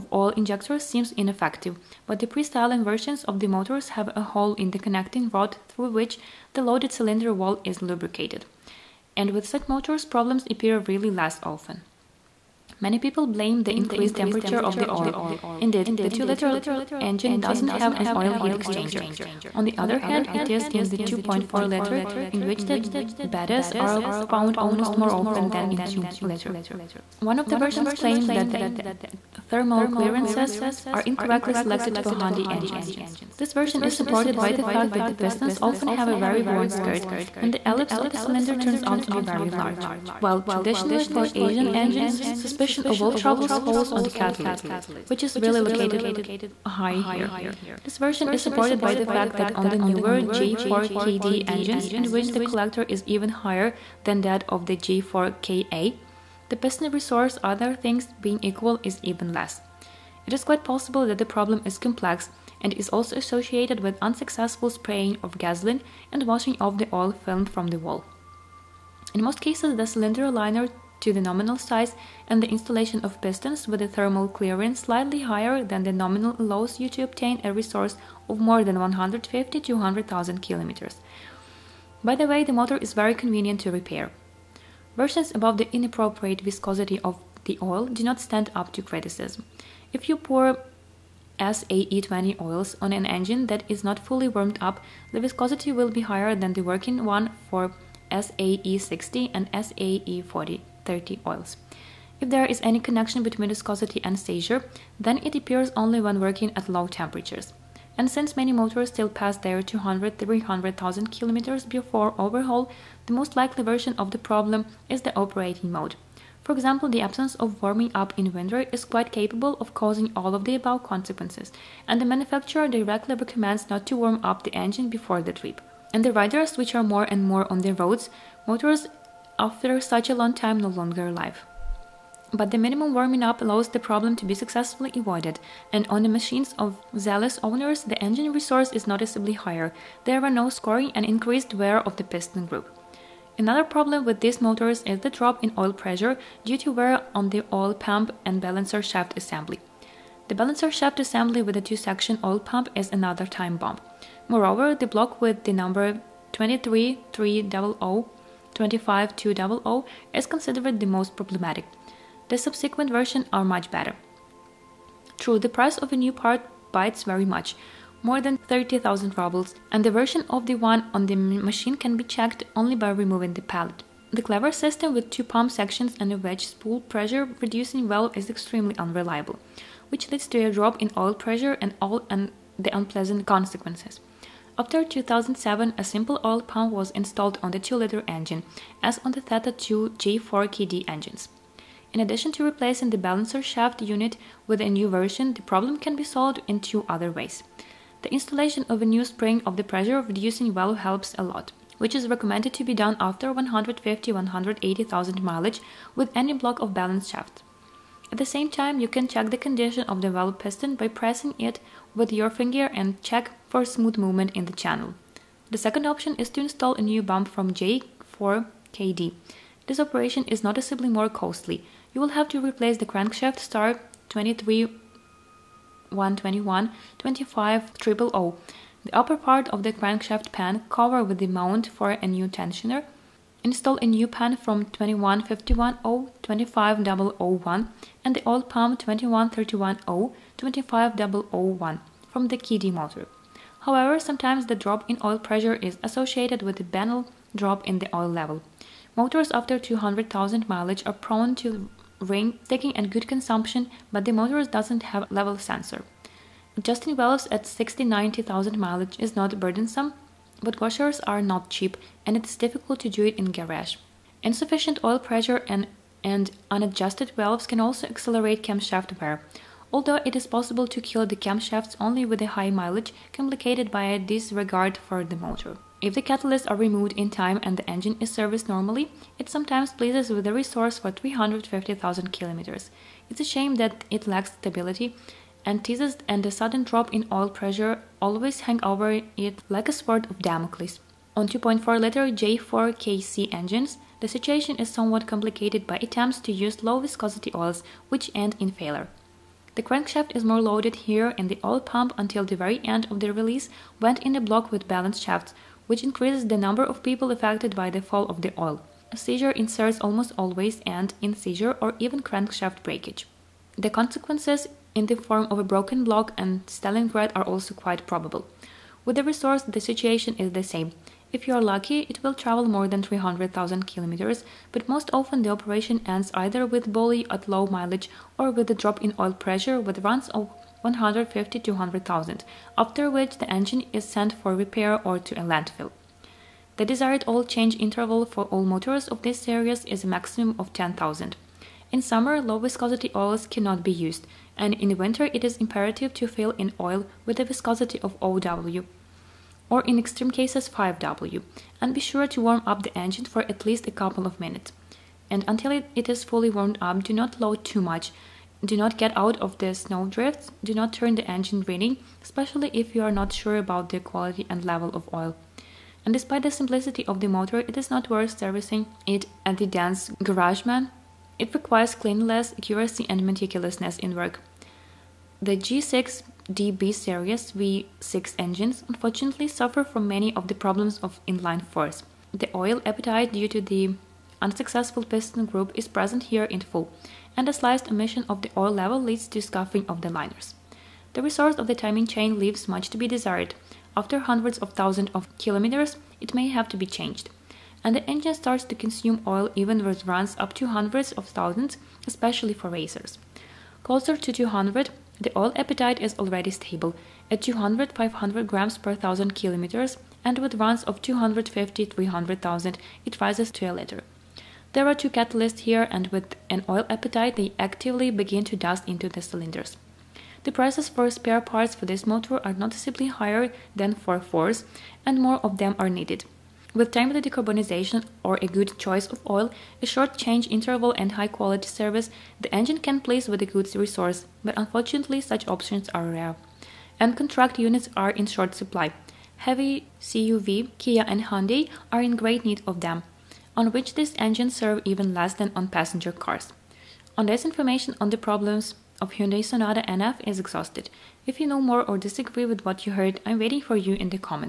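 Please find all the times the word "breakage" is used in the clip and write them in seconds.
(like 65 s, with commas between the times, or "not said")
312 s.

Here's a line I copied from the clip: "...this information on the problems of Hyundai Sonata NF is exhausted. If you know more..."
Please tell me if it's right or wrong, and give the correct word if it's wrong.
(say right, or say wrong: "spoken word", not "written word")
right.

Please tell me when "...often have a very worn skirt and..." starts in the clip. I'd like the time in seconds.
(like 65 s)
35 s.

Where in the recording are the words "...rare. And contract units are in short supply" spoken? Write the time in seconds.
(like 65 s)
435 s.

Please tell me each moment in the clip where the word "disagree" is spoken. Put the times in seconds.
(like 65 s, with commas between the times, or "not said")
451 s.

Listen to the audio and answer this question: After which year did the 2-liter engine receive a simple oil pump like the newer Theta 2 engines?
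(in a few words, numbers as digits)
2007.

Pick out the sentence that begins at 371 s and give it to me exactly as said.
It requires cleanliness, accuracy, and meticulousness in work.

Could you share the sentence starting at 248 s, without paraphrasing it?
Motors after 200,000 mileage are prone to ring sticking and good consumption, but the motor doesn't have level sensor.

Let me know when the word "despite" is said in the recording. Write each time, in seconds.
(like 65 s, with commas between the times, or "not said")
365 s.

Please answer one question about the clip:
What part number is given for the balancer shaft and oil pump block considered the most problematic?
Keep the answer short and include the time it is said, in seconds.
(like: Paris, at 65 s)
23300 25200, at 156 s.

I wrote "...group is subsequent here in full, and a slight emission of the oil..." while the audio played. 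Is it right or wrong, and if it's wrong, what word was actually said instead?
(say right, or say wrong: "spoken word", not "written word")
wrong: "present", not "subsequent".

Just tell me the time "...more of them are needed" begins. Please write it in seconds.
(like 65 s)
425 s.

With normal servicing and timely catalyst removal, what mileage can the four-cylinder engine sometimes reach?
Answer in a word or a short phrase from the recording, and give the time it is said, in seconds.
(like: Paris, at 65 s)
350,000 kilometers, at 280 s.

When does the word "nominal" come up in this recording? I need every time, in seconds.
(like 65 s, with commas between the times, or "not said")
71 s, 75 s.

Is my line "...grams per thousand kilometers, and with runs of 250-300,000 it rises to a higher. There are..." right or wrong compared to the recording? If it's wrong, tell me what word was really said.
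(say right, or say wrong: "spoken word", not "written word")
wrong: "liter", not "higher".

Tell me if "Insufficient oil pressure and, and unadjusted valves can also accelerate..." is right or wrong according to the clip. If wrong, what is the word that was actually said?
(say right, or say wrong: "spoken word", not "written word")
right.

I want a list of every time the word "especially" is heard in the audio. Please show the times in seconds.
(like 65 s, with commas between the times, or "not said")
362 s, 401 s.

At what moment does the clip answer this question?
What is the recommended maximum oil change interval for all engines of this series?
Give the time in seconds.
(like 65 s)
340 s.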